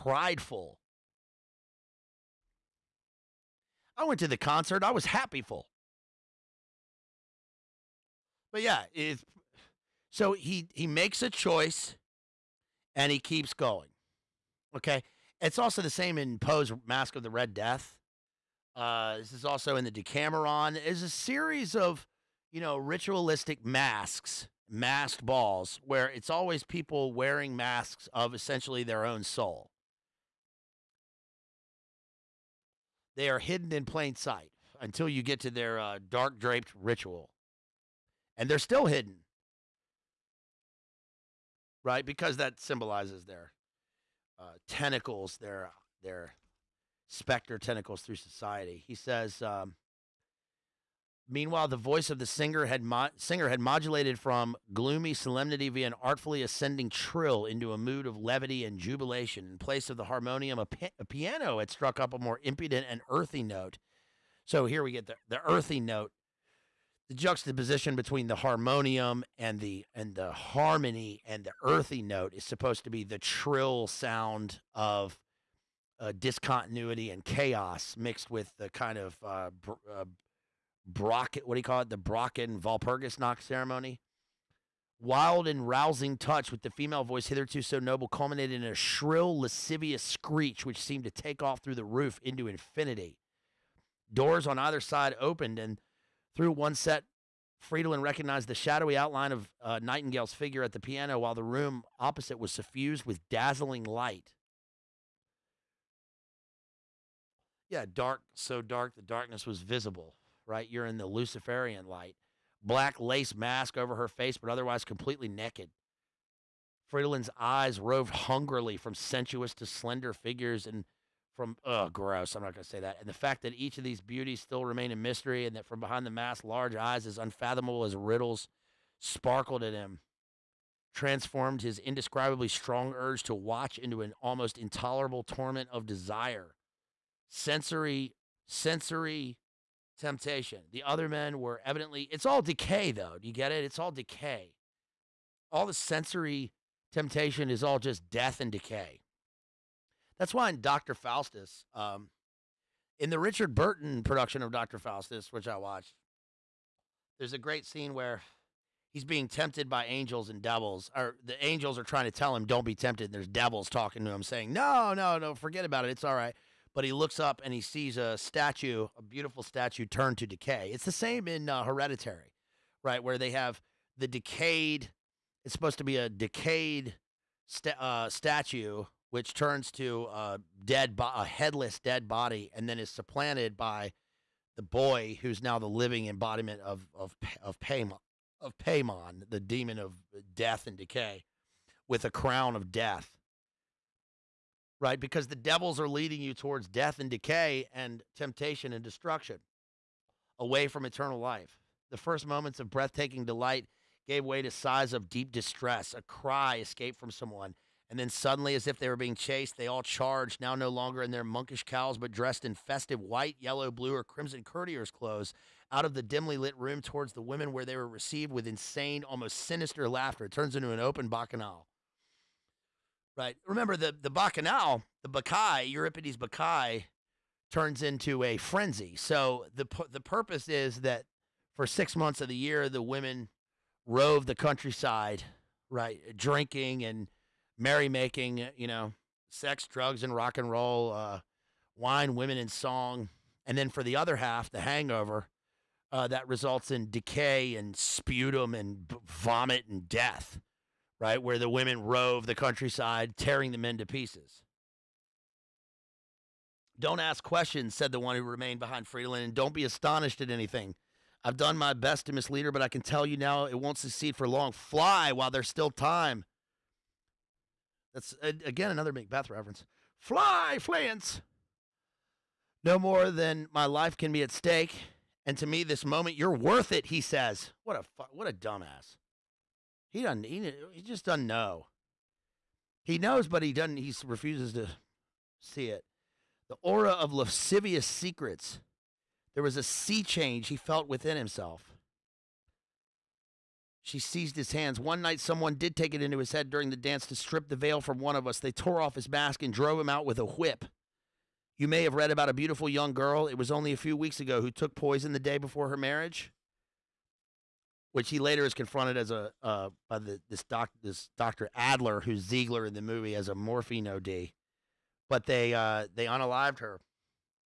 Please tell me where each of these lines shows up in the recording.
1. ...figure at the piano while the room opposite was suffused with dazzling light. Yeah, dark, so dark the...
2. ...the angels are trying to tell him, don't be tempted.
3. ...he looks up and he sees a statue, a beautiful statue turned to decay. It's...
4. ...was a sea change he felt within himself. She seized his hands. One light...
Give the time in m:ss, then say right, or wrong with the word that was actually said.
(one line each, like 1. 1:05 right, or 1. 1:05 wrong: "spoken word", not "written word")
1. 1:40 right
2. 2:41 right
3. 2:46 right
4. 4:49 wrong: "night", not "light".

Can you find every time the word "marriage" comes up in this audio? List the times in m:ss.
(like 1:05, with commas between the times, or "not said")
5:05.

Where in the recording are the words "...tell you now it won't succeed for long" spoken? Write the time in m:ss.
4:22.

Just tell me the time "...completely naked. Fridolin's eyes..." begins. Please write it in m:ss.
1:54.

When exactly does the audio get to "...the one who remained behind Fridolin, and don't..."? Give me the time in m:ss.
4:17.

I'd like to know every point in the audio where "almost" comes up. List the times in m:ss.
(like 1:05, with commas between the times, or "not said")
2:14, 3:39.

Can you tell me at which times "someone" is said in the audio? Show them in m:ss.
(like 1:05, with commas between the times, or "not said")
3:27, 4:55.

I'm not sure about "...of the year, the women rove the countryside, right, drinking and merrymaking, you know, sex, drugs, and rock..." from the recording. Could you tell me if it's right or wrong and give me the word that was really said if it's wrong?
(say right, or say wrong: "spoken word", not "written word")
right.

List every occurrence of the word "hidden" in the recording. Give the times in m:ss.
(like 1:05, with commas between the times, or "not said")
0:33, 0:38.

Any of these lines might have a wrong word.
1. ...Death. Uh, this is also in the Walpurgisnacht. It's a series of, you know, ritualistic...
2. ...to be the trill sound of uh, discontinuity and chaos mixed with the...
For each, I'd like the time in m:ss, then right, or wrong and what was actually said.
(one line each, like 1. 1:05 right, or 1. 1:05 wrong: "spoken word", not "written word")
1. 0:17 wrong: "Decameron", not "Walpurgisnacht"
2. 1:12 right.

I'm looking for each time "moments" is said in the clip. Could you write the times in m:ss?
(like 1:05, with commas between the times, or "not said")
3:22, 4:35.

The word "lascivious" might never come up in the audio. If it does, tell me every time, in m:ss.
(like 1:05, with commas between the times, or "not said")
1:29, 4:47.